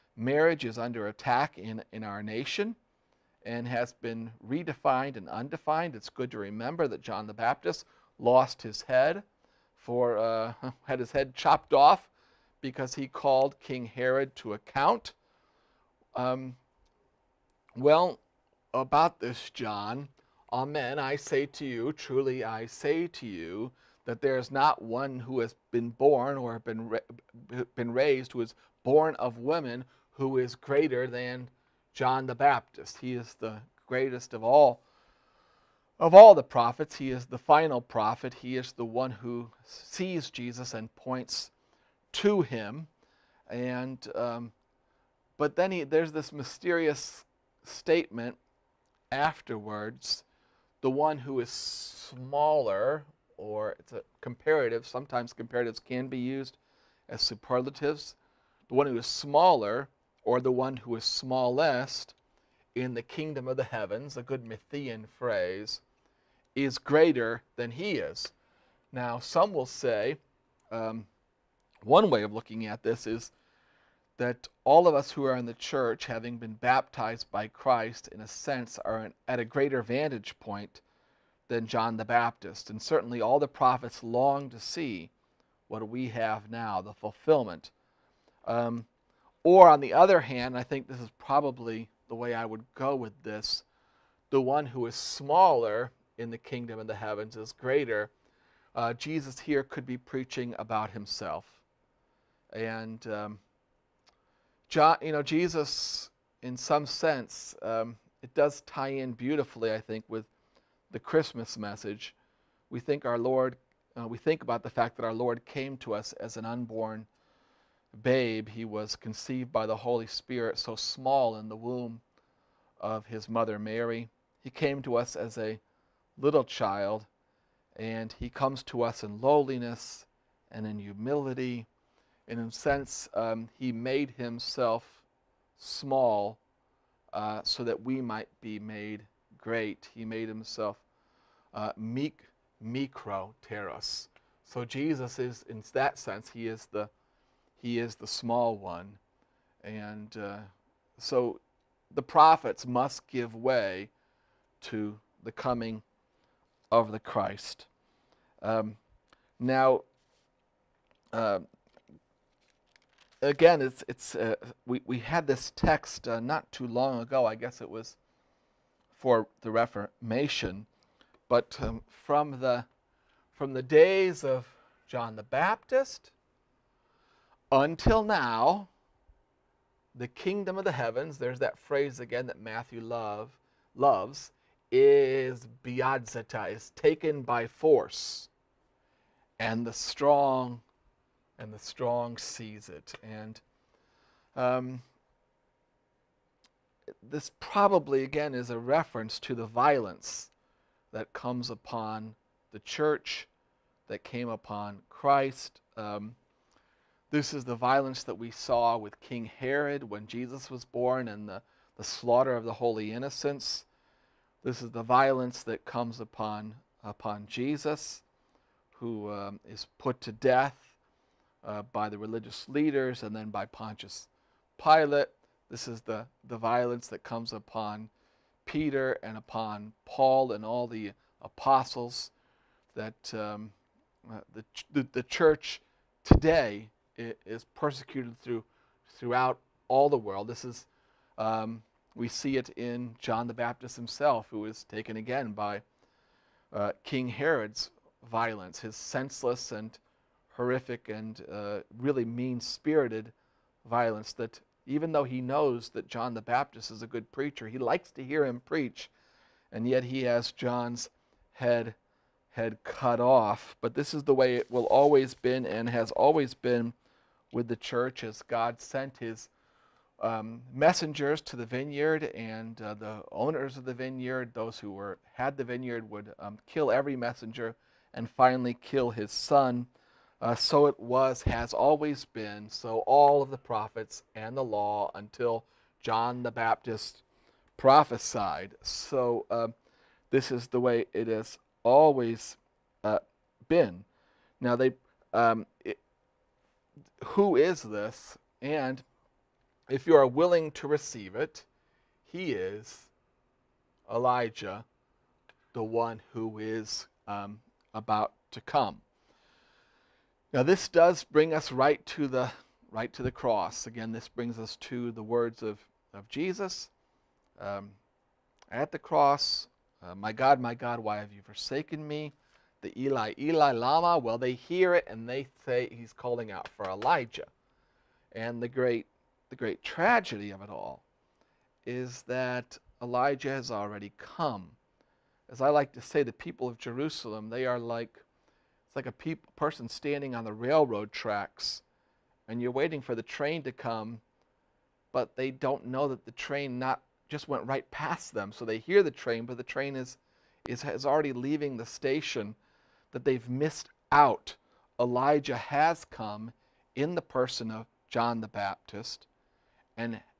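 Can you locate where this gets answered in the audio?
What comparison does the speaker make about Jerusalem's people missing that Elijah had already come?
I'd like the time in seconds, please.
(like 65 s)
340 s.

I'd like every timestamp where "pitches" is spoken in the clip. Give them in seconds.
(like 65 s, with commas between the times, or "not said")
not said.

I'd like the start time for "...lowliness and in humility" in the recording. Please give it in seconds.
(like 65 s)
129 s.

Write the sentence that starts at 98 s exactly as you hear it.
Uh, Jesus here could be preaching about himself.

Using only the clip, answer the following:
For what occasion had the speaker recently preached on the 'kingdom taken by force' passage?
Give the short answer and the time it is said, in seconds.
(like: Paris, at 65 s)
the Reformation, at 169 s.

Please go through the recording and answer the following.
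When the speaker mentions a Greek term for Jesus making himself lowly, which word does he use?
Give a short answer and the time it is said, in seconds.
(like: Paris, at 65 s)
micro teros, at 142 s.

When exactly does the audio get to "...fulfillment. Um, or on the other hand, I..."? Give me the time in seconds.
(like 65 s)
86 s.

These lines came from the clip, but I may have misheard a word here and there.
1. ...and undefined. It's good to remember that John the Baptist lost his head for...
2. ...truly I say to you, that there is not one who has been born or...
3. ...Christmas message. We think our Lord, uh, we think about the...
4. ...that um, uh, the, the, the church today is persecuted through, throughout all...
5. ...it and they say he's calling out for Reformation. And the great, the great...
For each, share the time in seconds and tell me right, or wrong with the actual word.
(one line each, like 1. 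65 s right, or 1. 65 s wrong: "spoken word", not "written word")
1. 5 s right
2. 21 s right
3. 110 s right
4. 232 s right
5. 324 s wrong: "Elijah", not "Reformation".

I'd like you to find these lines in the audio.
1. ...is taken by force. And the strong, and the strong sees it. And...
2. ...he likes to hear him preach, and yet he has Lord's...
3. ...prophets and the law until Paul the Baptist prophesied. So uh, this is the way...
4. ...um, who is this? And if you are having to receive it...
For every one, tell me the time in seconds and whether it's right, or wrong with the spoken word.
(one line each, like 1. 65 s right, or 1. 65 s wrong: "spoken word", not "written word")
1. 186 s right
2. 257 s wrong: "John", not "Lord"
3. 283 s wrong: "John", not "Paul"
4. 295 s wrong: "willing", not "having".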